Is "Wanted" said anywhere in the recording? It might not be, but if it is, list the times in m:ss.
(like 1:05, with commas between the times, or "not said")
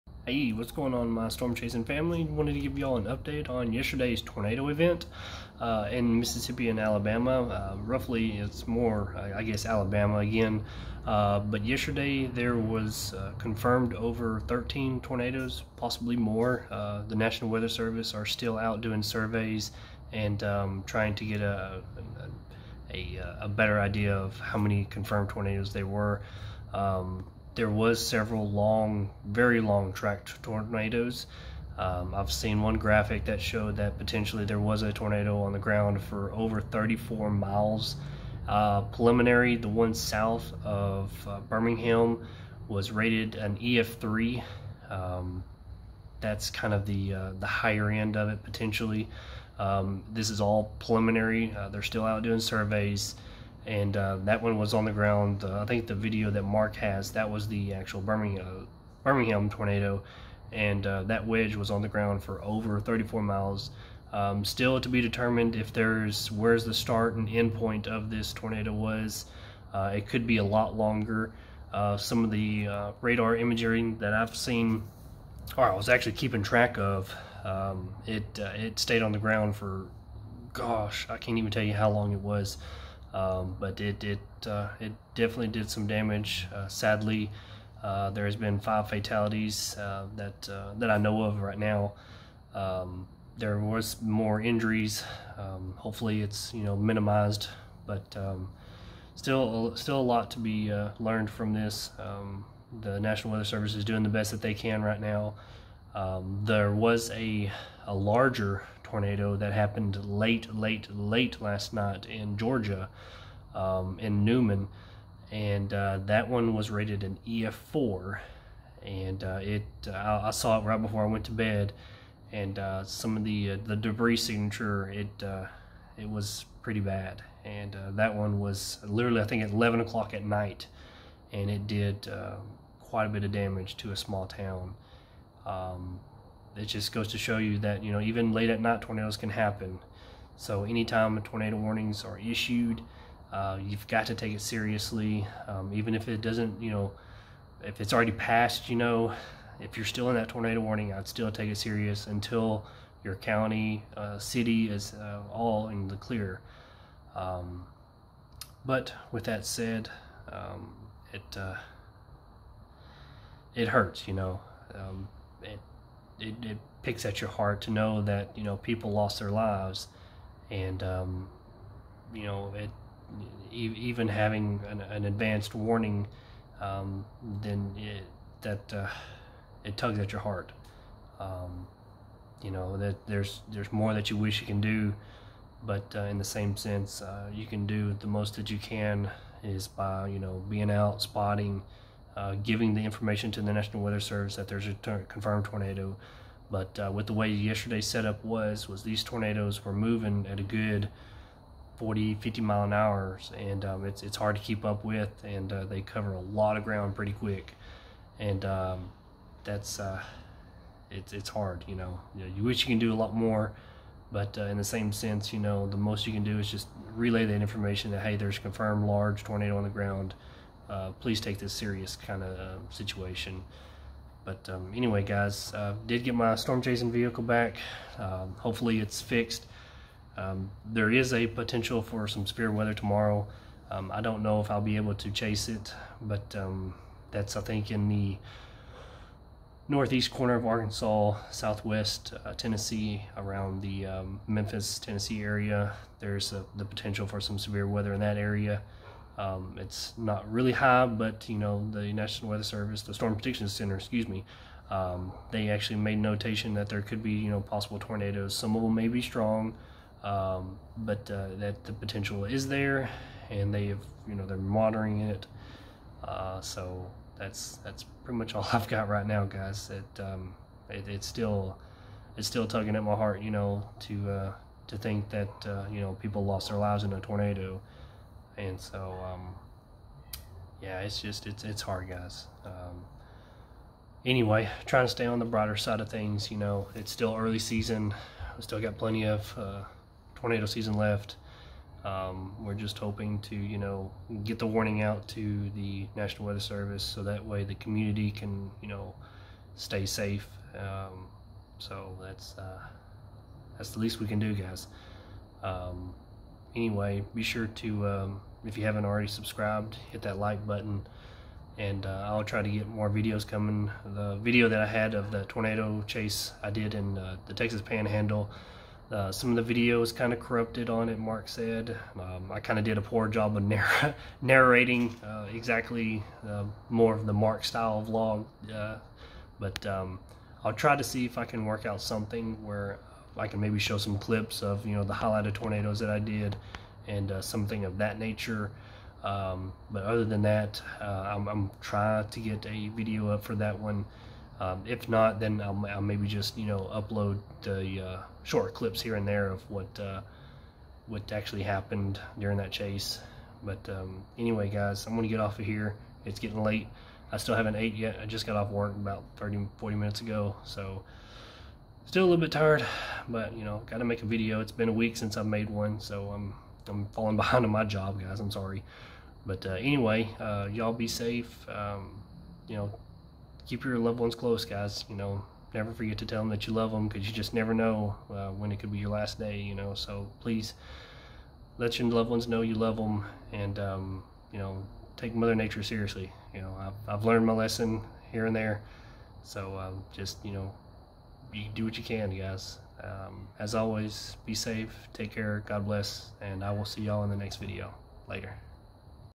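0:02.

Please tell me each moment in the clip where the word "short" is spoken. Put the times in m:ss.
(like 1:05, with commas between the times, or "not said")
5:48.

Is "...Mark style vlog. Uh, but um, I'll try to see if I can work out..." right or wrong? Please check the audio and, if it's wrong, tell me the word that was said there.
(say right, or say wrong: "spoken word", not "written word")
right.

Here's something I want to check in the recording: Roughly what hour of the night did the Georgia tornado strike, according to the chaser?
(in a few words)
11 o'clock.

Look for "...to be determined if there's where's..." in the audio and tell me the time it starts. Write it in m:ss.
1:04.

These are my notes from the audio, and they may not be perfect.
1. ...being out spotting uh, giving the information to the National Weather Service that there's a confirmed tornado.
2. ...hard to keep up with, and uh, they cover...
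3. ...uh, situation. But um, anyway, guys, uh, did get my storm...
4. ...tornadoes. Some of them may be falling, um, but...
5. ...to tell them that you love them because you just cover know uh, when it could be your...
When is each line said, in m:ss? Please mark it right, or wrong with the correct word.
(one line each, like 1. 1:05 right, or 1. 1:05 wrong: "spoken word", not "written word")
1. 3:10 right
2. 3:24 right
3. 3:42 right
4. 4:17 wrong: "strong", not "falling"
5. 6:15 wrong: "never", not "cover".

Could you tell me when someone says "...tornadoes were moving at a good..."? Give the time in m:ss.
3:19.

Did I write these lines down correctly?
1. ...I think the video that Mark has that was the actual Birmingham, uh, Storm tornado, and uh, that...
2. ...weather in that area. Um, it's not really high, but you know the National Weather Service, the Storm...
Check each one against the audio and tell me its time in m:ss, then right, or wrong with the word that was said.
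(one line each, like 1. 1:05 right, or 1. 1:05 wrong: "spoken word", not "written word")
1. 0:55 wrong: "Birmingham", not "Storm"
2. 4:07 right.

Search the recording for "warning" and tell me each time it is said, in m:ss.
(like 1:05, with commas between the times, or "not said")
2:21, 2:30, 2:55, 4:54.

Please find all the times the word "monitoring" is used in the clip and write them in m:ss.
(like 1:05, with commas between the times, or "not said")
4:24.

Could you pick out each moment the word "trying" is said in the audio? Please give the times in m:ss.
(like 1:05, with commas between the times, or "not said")
0:20, 4:44, 5:41.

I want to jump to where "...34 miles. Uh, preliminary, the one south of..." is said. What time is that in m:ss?
0:36.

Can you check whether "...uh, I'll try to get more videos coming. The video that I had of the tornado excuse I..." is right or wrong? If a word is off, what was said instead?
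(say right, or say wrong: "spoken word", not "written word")
wrong: "chase", not "excuse".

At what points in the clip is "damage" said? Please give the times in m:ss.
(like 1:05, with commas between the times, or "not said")
1:25, 2:13.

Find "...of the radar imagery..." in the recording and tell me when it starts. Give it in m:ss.
1:12.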